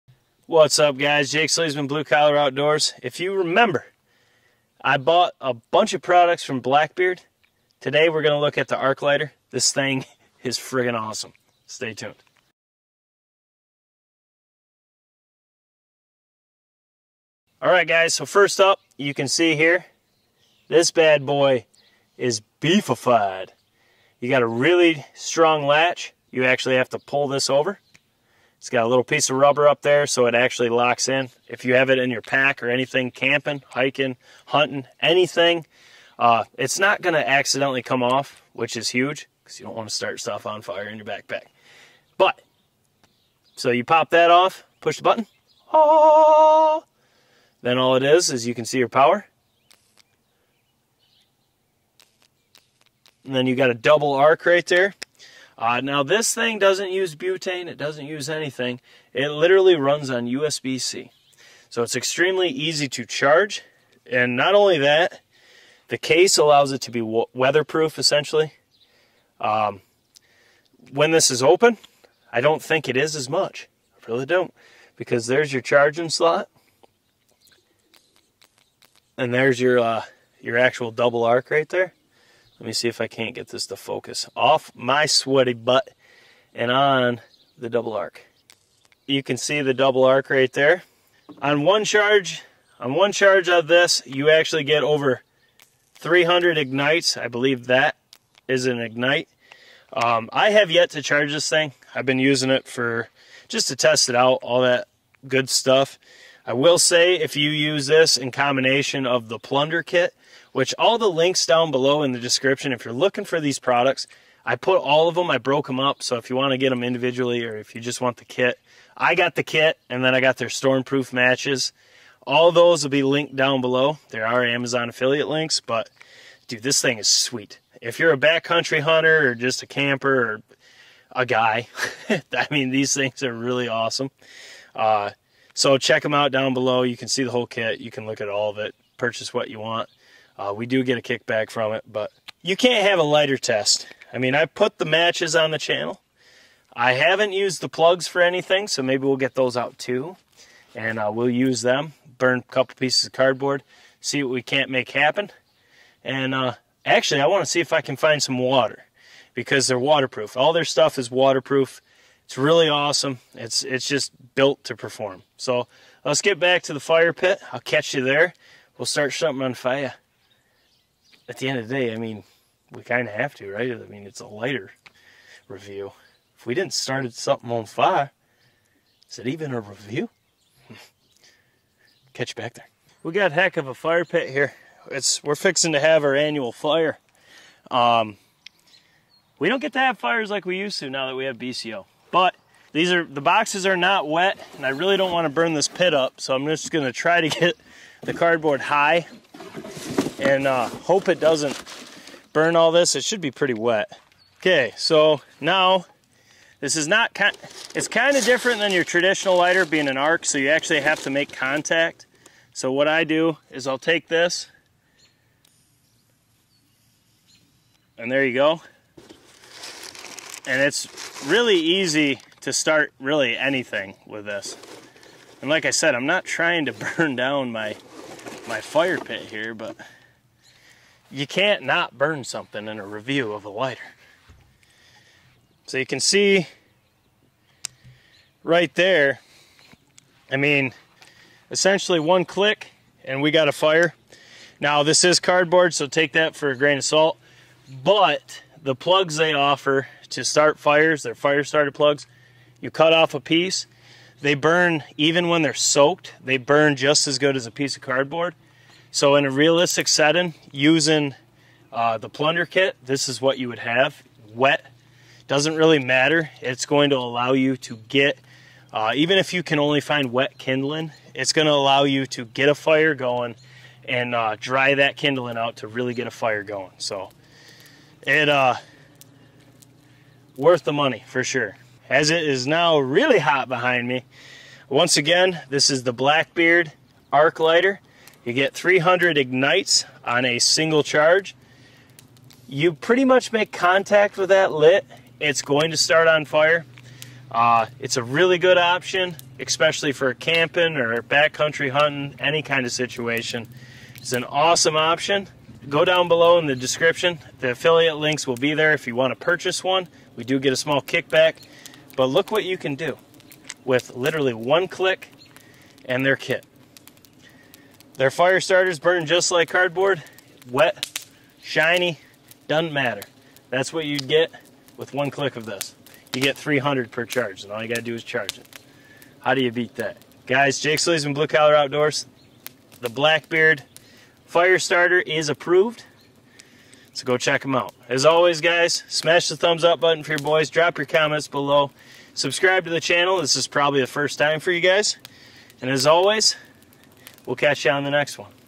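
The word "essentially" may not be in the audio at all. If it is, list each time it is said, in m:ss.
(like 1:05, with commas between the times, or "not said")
1:07, 4:01.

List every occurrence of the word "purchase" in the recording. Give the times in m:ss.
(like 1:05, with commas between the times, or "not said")
2:18, 5:09.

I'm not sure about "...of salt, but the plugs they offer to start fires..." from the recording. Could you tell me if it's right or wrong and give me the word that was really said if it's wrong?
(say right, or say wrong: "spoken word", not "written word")
right.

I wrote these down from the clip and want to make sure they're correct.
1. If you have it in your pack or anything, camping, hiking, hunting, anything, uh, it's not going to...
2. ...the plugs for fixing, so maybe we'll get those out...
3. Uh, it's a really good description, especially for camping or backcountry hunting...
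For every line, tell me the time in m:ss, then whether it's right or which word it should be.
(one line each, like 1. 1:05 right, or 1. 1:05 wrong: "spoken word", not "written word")
1. 0:31 right
2. 2:27 wrong: "anything", not "fixing"
3. 4:57 wrong: "option", not "description".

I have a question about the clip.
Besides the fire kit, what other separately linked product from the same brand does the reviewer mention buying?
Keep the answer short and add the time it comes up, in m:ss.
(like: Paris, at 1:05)
stormproof matches, at 2:00.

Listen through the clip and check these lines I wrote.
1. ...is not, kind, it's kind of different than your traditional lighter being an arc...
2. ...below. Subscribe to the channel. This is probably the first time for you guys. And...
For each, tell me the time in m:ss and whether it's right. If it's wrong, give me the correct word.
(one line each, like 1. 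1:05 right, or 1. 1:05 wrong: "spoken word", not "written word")
1. 3:26 right
2. 5:41 right.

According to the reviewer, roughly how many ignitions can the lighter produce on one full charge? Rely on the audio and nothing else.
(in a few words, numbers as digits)
over 300.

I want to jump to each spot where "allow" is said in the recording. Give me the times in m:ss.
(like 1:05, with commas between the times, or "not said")
1:06, 4:26, 4:31.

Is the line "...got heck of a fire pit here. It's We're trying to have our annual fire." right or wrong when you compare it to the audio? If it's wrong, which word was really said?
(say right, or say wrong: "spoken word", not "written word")
wrong: "fixing", not "trying".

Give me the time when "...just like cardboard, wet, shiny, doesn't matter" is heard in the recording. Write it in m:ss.
5:19.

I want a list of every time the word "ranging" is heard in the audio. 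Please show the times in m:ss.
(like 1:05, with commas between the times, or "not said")
not said.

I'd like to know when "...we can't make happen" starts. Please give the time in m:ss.
2:34.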